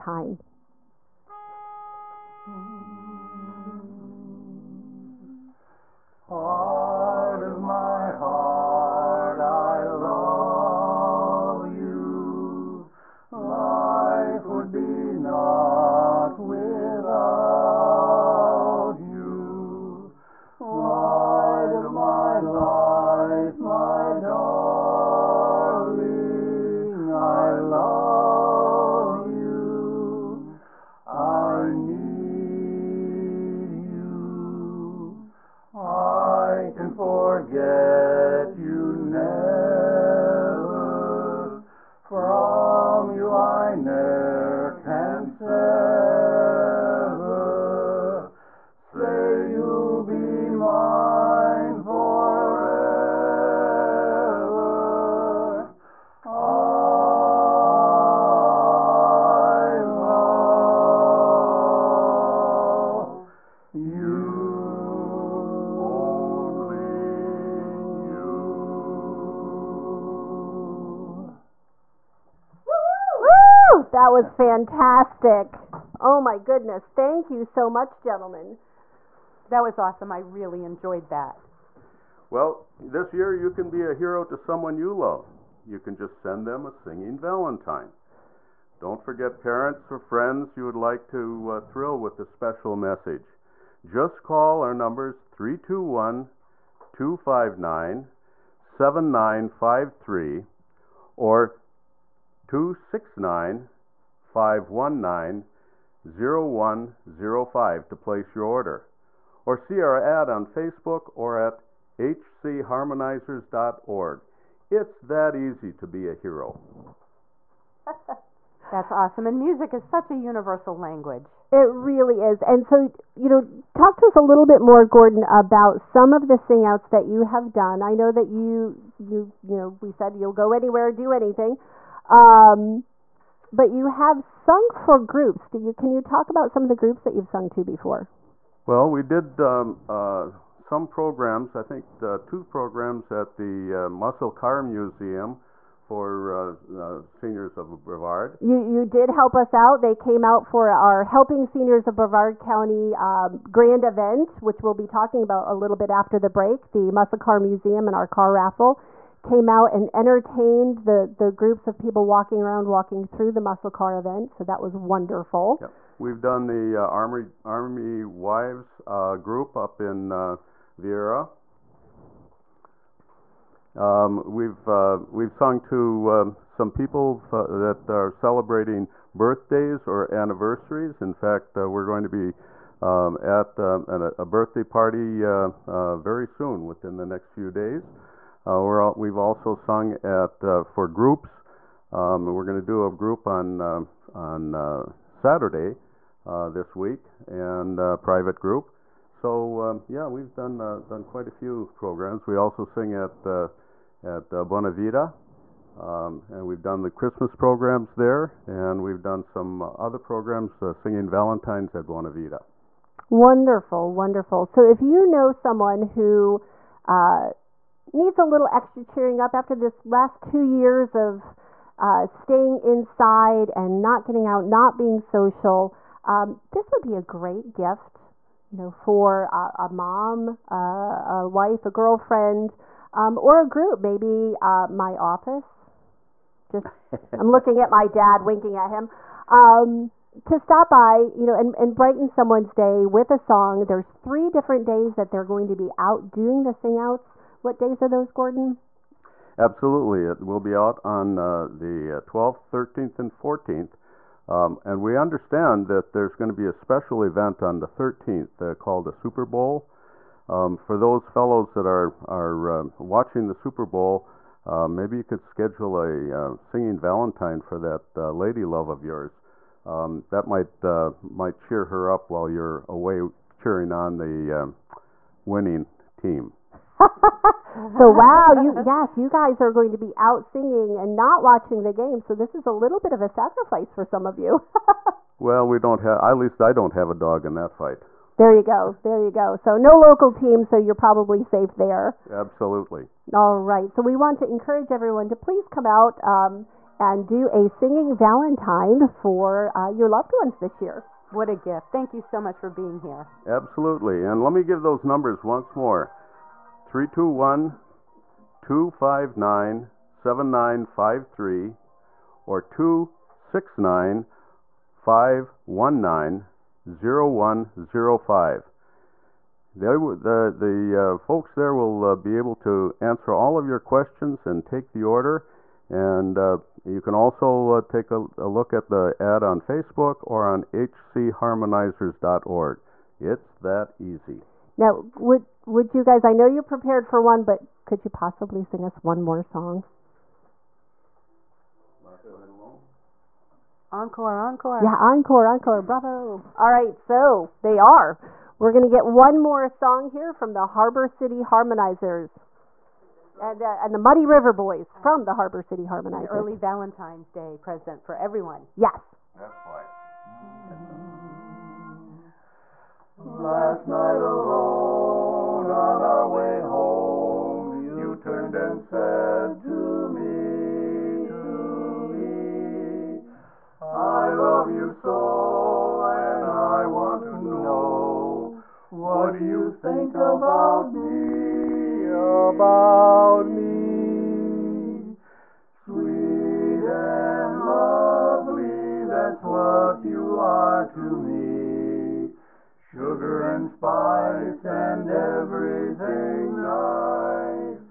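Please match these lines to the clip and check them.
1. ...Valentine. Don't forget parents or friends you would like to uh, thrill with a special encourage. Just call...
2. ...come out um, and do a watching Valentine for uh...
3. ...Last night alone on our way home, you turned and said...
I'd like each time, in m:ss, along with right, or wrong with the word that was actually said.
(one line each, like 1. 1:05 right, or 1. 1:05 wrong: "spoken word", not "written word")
1. 1:27 wrong: "message", not "encourage"
2. 4:55 wrong: "singing", not "watching"
3. 6:02 right.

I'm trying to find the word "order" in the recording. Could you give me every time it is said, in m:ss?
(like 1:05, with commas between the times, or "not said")
1:48, 5:24.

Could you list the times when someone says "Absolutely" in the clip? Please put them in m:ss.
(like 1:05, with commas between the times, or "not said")
4:09, 4:52, 5:03.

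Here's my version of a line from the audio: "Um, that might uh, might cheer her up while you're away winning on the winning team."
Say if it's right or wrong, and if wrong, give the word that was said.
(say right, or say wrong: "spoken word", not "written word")
wrong: "cheering", not "winning".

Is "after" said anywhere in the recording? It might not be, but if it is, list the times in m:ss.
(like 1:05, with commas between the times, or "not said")
2:35, 3:39.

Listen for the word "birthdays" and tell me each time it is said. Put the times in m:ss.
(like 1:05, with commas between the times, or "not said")
2:59, 3:04.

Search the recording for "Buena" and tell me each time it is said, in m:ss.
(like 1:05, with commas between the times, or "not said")
3:24, 3:31.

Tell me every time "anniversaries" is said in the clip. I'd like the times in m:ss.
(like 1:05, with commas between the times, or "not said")
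3:00.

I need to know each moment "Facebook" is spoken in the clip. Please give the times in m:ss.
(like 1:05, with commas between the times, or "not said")
1:50, 5:29.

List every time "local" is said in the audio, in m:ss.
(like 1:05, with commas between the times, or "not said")
4:49.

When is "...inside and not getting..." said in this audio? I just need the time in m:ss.
3:42.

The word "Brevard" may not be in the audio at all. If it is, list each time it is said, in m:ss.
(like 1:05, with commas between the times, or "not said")
2:27, 2:31.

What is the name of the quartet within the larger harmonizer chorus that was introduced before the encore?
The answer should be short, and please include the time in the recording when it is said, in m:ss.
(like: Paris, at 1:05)
Muddy River Boys, at 5:53.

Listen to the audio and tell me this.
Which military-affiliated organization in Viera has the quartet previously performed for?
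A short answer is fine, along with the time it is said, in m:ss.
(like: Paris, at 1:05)
Army Wives, at 2:47.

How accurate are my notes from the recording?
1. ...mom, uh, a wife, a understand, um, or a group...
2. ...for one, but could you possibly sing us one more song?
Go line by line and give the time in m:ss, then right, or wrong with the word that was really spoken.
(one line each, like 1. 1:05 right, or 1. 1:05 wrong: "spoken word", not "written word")
1. 3:49 wrong: "girlfriend", not "understand"
2. 5:36 right.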